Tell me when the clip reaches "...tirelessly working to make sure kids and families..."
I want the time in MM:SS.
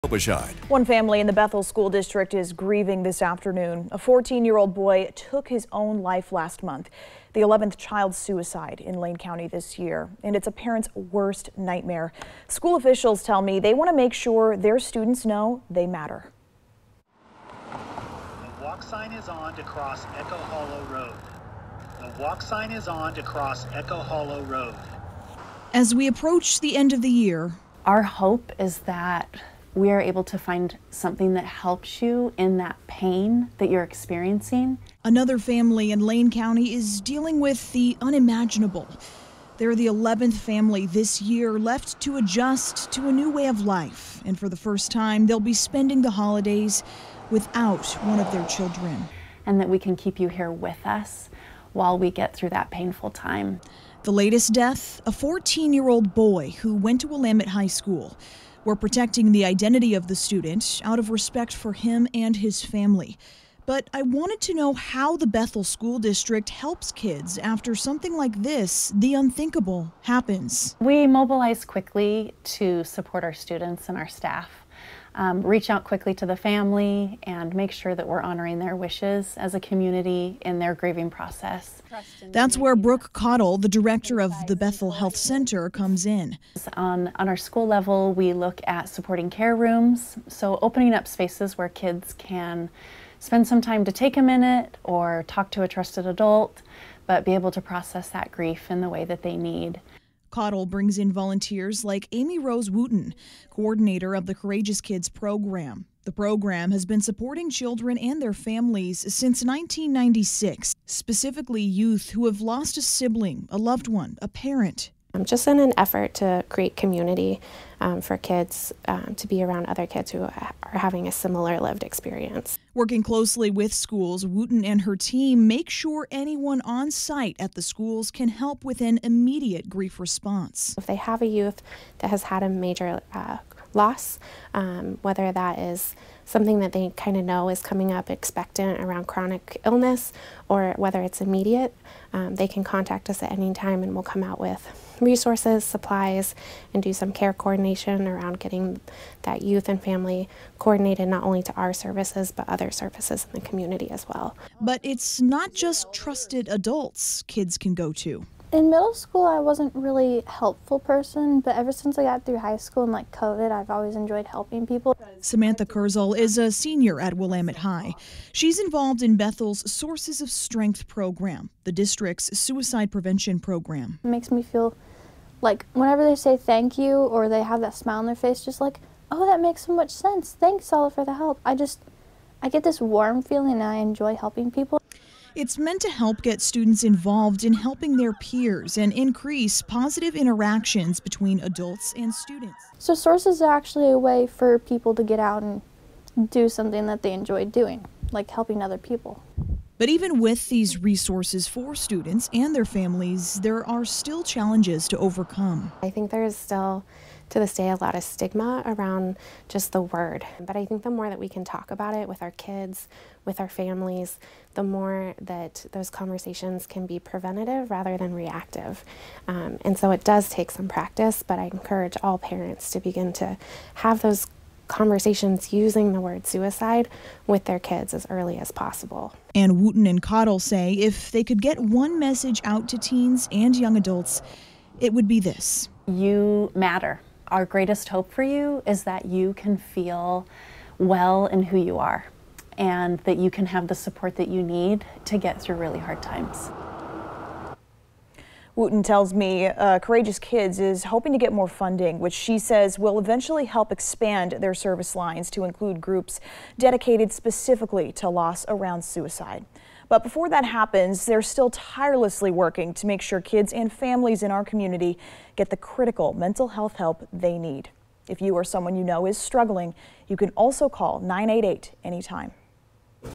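04:21.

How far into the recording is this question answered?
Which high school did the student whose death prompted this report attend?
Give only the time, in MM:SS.
00:57.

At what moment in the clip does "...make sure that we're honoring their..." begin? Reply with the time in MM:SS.
01:17.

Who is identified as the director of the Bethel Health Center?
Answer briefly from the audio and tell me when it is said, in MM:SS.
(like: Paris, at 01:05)
Brooke Cottle, at 01:22.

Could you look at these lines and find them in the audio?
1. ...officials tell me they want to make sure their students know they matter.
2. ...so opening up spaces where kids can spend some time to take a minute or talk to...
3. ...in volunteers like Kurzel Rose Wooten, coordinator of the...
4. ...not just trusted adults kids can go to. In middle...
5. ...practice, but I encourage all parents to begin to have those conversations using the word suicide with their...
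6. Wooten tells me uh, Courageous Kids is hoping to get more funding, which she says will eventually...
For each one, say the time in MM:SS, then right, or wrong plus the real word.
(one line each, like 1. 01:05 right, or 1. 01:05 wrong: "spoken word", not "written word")
1. 00:12 right
2. 01:30 right
3. 01:40 wrong: "Amy", not "Kurzel"
4. 02:35 right
5. 03:40 right
6. 04:08 right.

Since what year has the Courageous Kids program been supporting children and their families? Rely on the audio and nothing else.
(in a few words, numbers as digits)
1996.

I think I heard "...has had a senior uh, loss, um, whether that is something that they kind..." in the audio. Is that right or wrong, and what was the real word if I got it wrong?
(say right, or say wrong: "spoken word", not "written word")
wrong: "major", not "senior".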